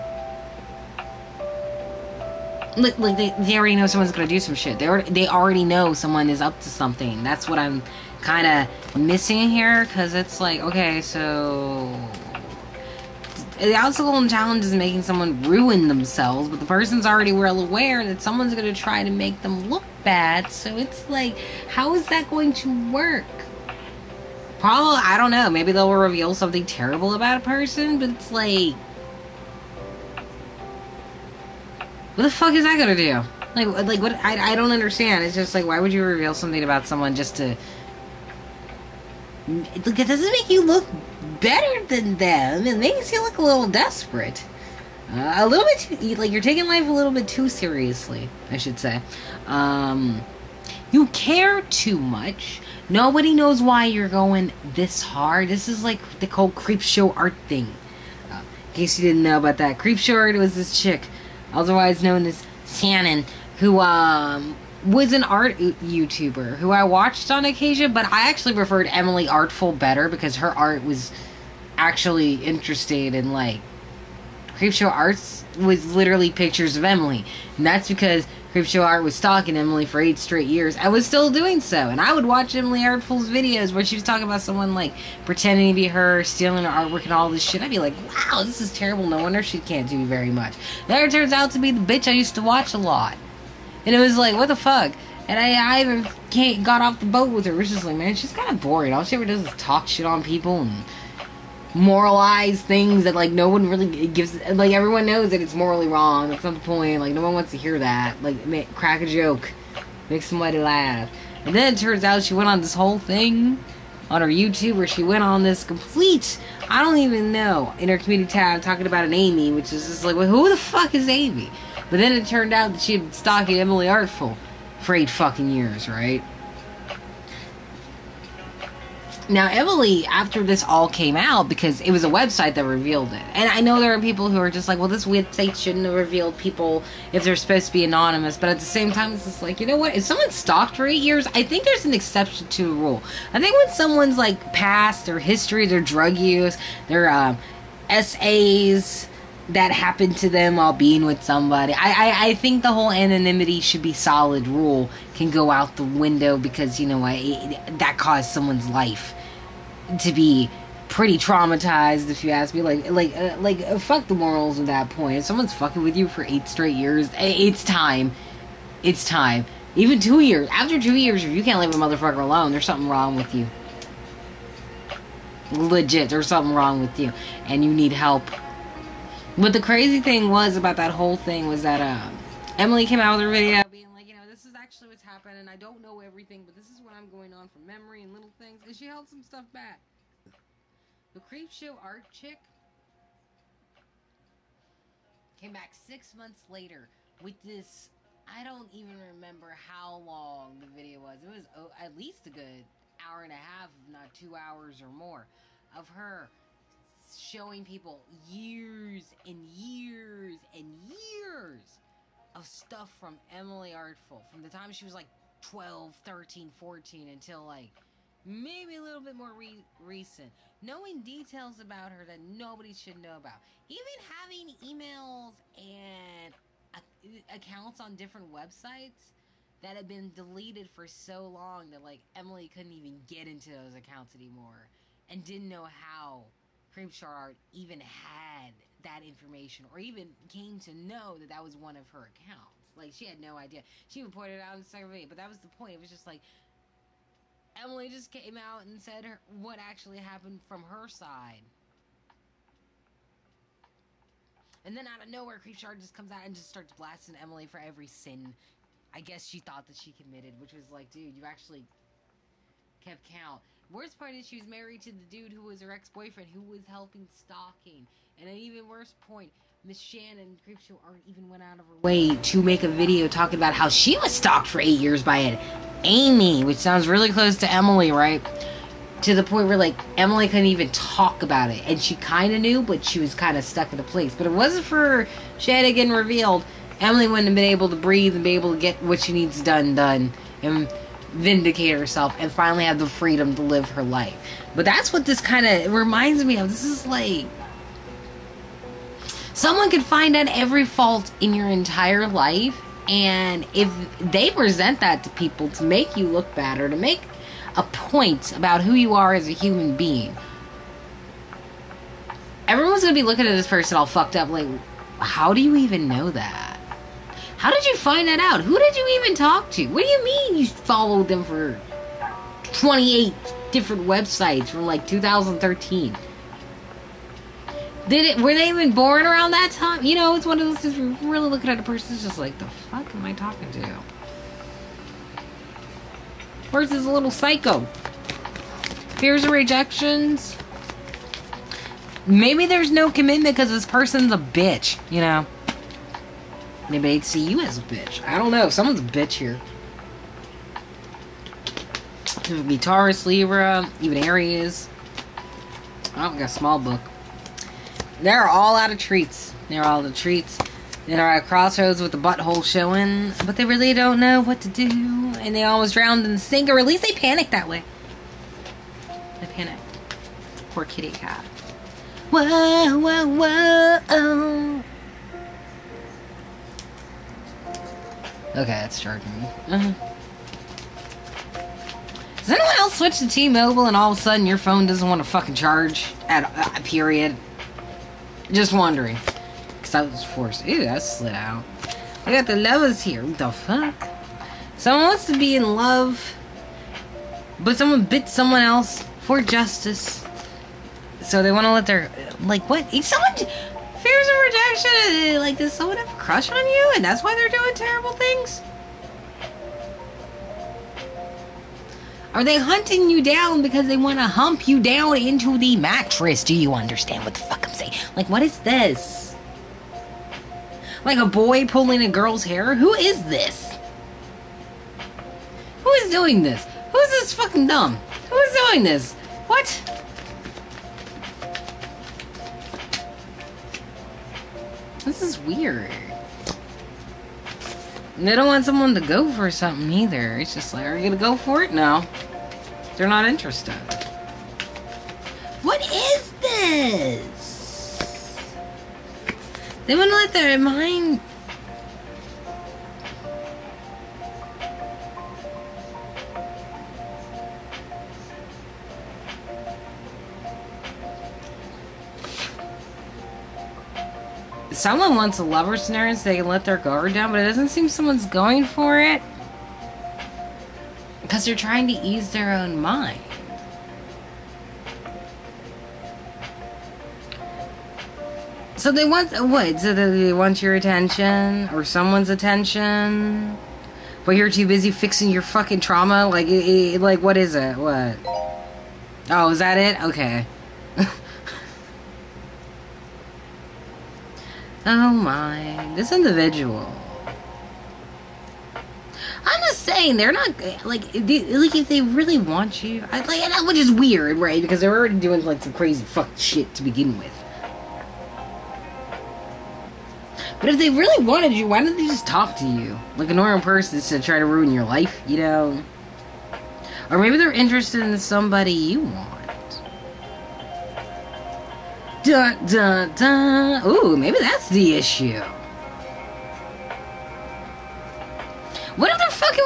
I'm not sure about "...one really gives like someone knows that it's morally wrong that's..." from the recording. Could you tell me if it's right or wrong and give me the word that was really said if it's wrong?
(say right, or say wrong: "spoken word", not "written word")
wrong: "everyone", not "someone".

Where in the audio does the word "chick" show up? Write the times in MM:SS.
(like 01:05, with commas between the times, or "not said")
01:00, 03:12.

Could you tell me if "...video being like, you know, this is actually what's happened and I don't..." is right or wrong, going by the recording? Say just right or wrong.
right.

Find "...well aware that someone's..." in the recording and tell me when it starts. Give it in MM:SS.
00:17.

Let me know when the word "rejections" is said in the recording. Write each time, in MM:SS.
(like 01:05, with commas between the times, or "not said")
05:39.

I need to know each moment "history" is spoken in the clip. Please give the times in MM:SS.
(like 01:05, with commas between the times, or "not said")
02:25.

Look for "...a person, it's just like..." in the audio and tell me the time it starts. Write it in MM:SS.
05:31.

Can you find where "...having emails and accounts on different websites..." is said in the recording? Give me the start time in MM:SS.
03:44.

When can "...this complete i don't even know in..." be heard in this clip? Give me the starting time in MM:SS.
01:55.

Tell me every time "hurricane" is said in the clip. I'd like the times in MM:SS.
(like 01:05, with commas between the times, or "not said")
not said.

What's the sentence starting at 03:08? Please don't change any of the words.
And she held some stuff back.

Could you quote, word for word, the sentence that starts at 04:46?
Emily wouldn't have been able to breathe and be able to get what she needs done done.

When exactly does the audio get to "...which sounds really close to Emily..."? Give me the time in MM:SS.
04:36.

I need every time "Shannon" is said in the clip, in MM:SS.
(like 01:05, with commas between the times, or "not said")
01:02, 04:29.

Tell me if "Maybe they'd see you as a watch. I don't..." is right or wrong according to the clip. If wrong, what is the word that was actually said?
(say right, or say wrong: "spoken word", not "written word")
wrong: "bitch", not "watch".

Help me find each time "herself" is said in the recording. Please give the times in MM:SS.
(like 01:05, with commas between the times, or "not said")
04:51.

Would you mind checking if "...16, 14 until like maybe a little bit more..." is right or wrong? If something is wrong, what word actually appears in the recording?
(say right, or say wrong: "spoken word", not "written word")
wrong: "13", not "16".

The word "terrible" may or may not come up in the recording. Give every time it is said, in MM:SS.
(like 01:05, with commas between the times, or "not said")
00:26, 01:28, 06:47.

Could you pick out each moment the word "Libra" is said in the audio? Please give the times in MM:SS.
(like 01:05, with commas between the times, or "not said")
05:53.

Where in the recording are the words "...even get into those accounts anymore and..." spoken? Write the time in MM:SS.
03:52.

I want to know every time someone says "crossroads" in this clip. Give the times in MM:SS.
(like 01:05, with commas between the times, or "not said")
06:01.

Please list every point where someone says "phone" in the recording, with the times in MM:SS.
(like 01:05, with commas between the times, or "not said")
06:24.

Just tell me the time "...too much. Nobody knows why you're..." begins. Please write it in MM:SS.
00:51.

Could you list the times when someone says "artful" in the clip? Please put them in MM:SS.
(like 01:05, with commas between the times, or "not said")
01:09, 01:22, 02:03, 03:33.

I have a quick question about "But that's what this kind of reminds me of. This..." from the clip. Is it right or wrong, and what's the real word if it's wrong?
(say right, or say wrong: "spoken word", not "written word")
right.